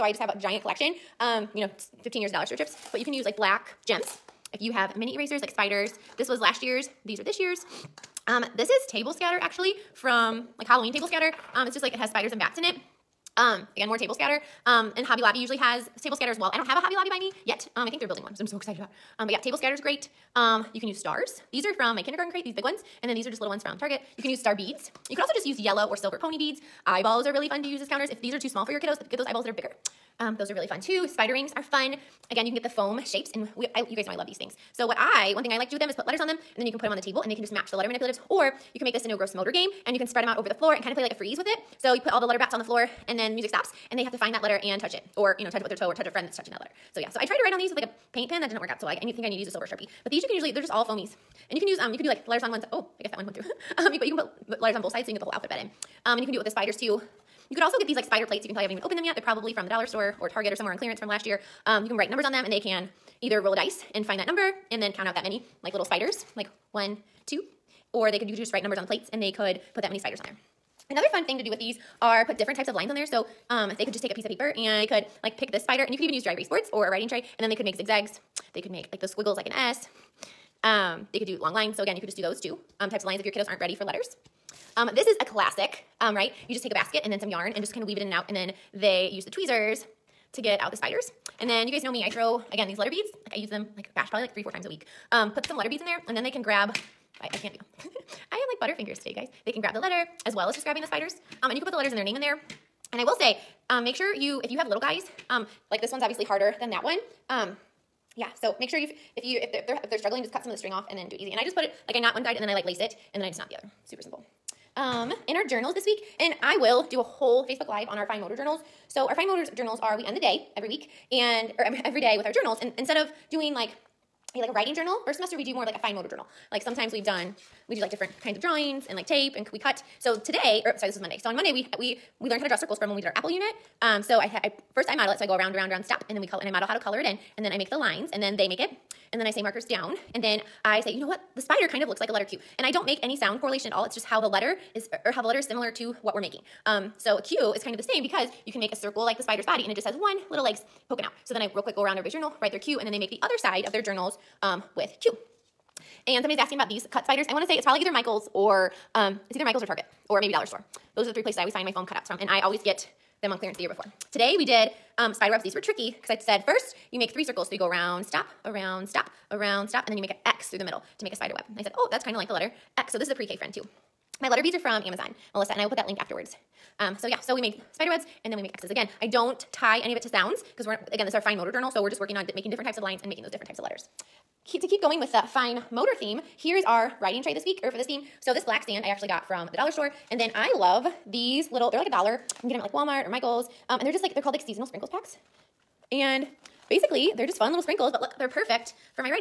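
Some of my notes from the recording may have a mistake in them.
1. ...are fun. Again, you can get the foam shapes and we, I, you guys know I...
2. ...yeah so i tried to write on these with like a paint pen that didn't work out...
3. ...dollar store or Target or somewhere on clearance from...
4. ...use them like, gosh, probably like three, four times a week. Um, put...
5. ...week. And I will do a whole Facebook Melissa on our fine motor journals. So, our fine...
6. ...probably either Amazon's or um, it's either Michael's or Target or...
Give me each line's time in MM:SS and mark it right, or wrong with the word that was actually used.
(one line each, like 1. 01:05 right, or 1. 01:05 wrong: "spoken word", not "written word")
1. 00:31 right
2. 00:46 right
3. 00:59 right
4. 01:33 right
5. 01:55 wrong: "Live", not "Melissa"
6. 02:37 wrong: "Michael", not "Amazon".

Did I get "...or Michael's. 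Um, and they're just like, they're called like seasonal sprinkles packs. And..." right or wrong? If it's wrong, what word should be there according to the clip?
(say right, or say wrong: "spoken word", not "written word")
right.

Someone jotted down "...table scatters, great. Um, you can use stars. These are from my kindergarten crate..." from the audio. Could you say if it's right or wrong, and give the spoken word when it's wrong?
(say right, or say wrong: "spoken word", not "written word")
right.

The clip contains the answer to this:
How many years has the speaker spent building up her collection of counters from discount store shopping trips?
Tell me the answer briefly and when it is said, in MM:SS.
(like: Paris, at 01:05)
15, at 00:02.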